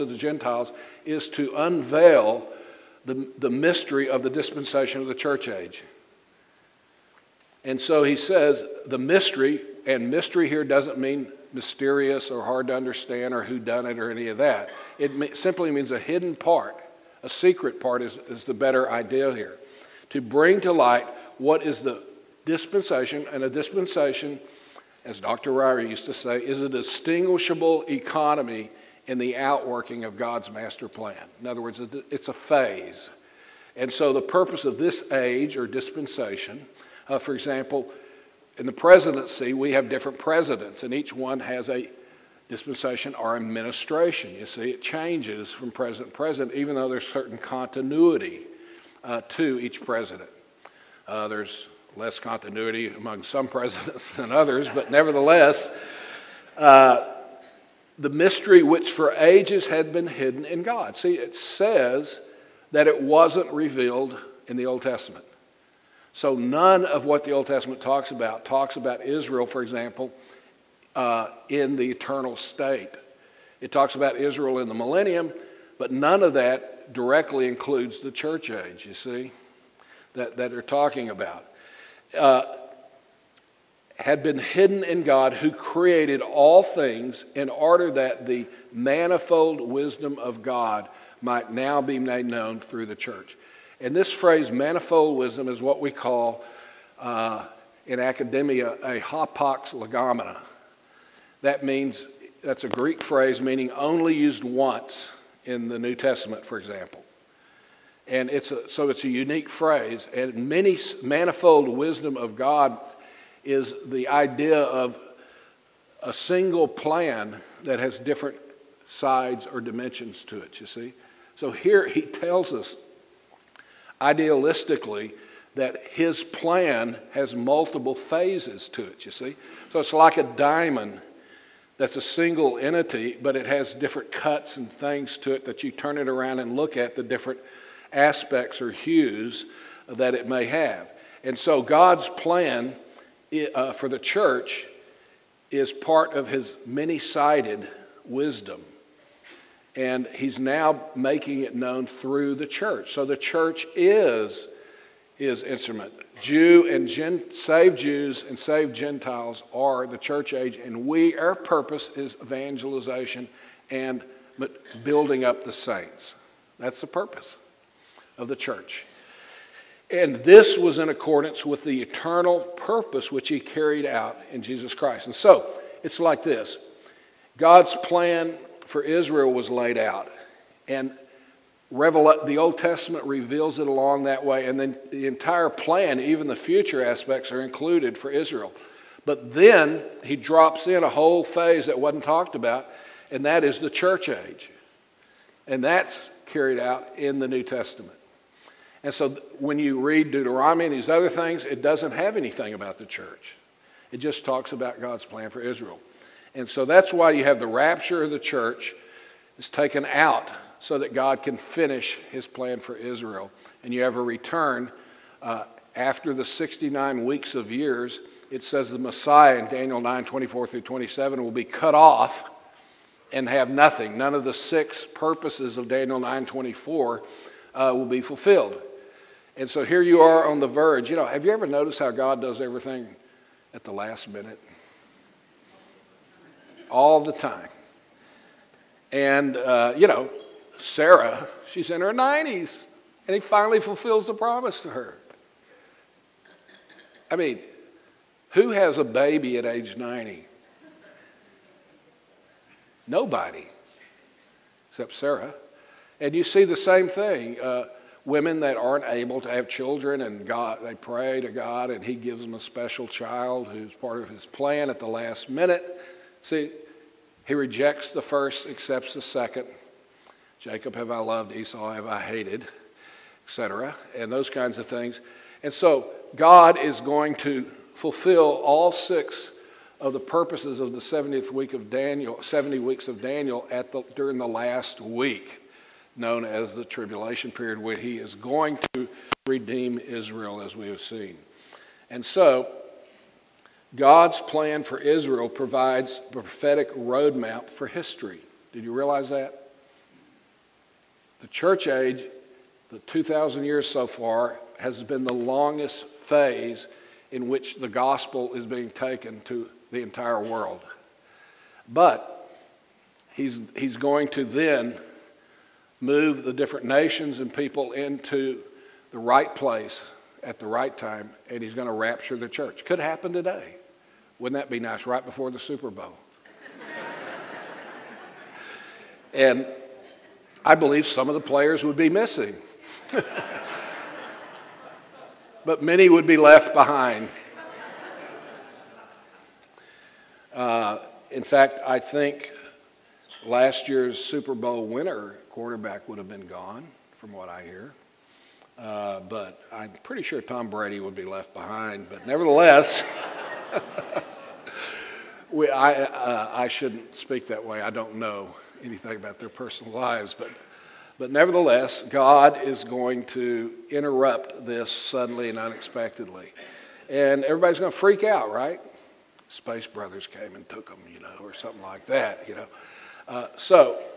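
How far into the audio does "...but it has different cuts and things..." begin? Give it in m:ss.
2:13.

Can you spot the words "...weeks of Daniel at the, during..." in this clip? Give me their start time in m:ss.
4:42.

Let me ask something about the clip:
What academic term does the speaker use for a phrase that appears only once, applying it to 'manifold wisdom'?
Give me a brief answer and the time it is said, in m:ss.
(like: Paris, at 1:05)
hapax legomena, at 1:38.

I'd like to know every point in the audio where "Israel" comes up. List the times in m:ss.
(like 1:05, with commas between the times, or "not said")
1:09, 1:14, 2:58, 3:08, 3:25, 3:32, 4:49, 4:54.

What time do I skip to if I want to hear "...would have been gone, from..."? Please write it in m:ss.
5:45.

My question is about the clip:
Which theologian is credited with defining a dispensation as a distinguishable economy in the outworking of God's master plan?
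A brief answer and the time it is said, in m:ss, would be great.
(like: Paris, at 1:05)
Dr. Ryrie, at 0:25.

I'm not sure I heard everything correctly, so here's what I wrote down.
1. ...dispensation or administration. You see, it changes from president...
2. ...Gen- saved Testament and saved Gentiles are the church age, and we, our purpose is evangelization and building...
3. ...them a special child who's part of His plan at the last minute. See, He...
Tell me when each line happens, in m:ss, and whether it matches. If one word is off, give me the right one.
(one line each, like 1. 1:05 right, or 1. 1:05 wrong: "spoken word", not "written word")
1. 0:42 right
2. 2:36 wrong: "Jews", not "Testament"
3. 4:22 right.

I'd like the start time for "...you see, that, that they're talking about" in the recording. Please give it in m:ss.
1:18.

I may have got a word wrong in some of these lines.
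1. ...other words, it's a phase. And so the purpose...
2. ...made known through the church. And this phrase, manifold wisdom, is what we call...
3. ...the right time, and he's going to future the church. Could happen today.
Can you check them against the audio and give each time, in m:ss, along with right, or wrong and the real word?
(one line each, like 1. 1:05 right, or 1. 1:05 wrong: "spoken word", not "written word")
1. 0:31 right
2. 1:31 right
3. 5:20 wrong: "rapture", not "future".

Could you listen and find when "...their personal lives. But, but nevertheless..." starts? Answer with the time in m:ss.
5:59.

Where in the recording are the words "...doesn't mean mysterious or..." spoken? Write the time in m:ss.
0:10.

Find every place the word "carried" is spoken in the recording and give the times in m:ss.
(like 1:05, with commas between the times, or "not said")
2:53, 3:16.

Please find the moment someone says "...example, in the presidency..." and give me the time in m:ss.
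0:37.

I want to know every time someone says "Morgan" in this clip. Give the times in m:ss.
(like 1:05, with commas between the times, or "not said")
not said.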